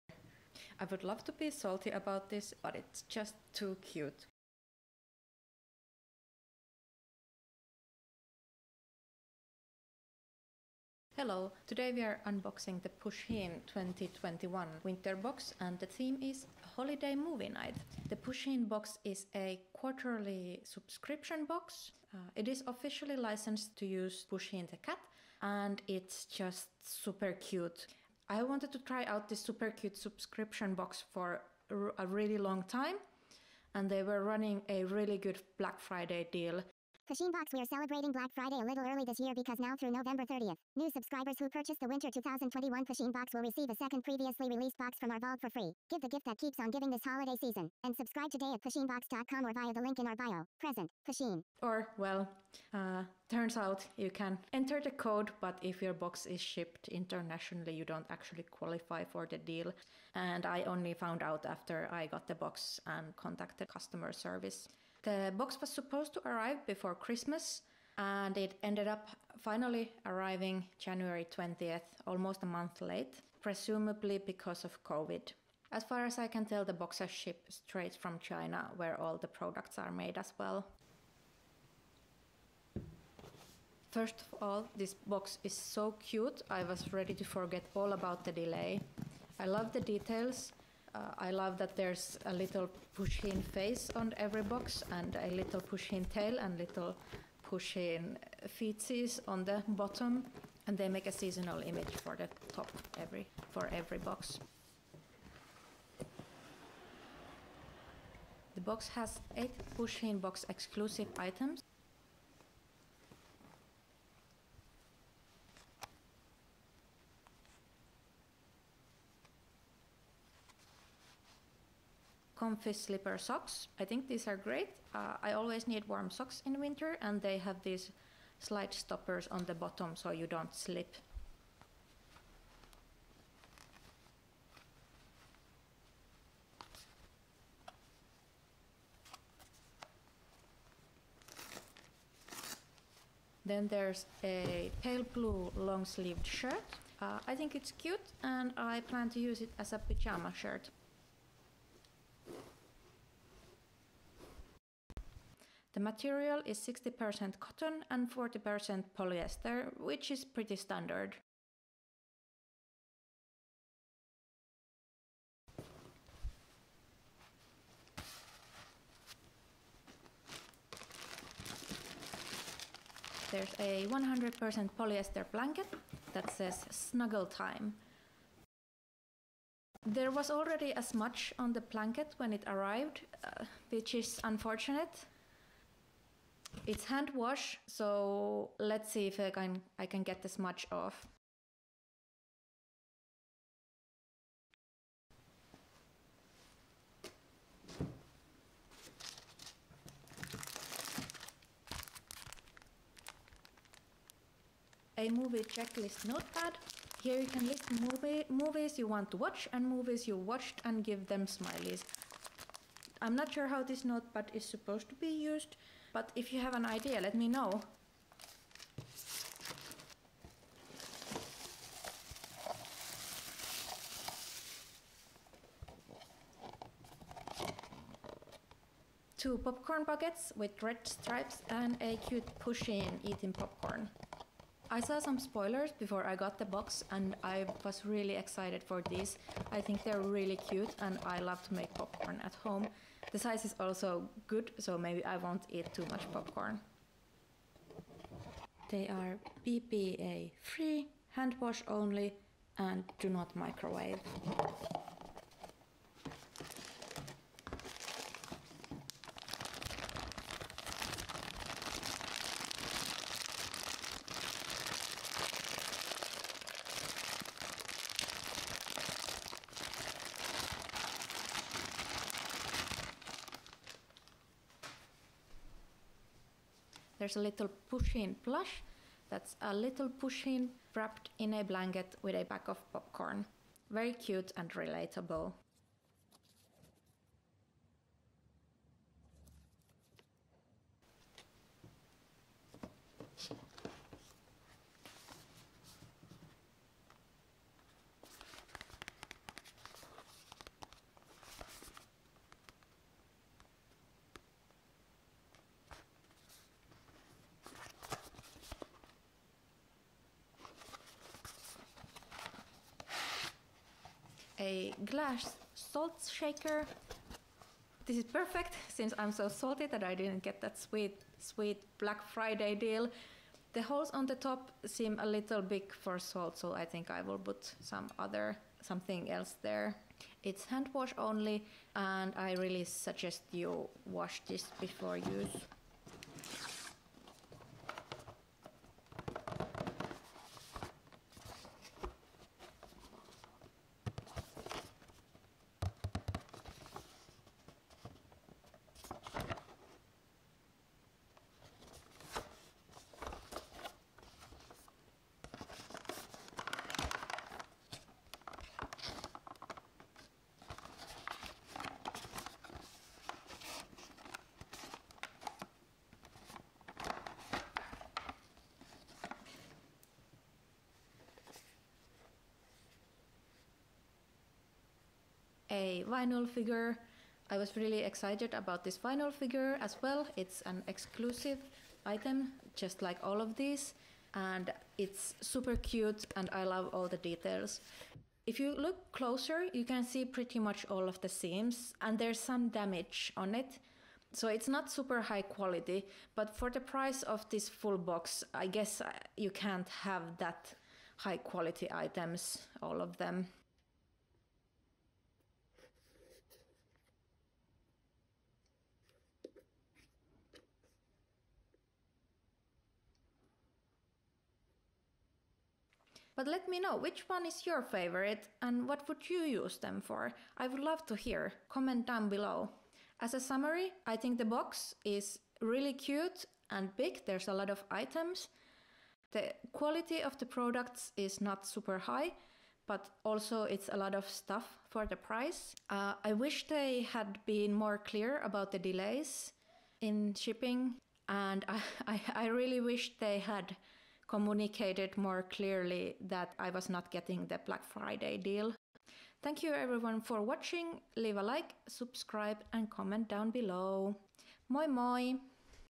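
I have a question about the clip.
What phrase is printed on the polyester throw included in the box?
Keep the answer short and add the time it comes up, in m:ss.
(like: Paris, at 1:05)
snuggle time, at 2:56.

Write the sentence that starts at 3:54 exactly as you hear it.
I saw some spoilers before I got the box and I was really excited for these.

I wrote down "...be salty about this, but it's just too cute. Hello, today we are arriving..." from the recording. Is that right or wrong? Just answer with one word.
wrong.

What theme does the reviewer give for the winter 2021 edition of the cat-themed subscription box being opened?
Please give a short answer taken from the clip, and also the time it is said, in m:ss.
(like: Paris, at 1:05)
holiday movie night, at 0:16.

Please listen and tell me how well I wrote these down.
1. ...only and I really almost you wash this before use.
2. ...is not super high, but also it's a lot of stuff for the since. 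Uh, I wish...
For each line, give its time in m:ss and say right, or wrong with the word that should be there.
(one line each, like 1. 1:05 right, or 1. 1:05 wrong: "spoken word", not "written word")
1. 5:30 wrong: "suggest", not "almost"
2. 7:10 wrong: "price", not "since".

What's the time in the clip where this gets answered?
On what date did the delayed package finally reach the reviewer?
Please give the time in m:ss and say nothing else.
1:10.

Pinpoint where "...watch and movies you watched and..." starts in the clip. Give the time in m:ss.
3:29.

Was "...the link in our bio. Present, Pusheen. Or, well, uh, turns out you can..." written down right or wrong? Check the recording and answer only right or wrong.
right.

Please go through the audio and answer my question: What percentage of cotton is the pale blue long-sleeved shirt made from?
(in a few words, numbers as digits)
60%.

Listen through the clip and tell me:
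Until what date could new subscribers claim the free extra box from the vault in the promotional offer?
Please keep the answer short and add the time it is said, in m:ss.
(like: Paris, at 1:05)
November 30th, at 0:39.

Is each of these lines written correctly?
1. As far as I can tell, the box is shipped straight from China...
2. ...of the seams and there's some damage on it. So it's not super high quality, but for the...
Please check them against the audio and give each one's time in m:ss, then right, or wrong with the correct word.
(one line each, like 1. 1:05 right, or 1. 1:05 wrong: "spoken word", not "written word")
1. 1:15 right
2. 6:30 right.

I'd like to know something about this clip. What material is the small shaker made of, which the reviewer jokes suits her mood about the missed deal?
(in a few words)
glass.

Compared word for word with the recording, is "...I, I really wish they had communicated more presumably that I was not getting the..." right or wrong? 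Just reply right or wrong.
wrong.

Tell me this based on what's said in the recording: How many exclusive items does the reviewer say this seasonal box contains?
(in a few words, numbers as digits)
8.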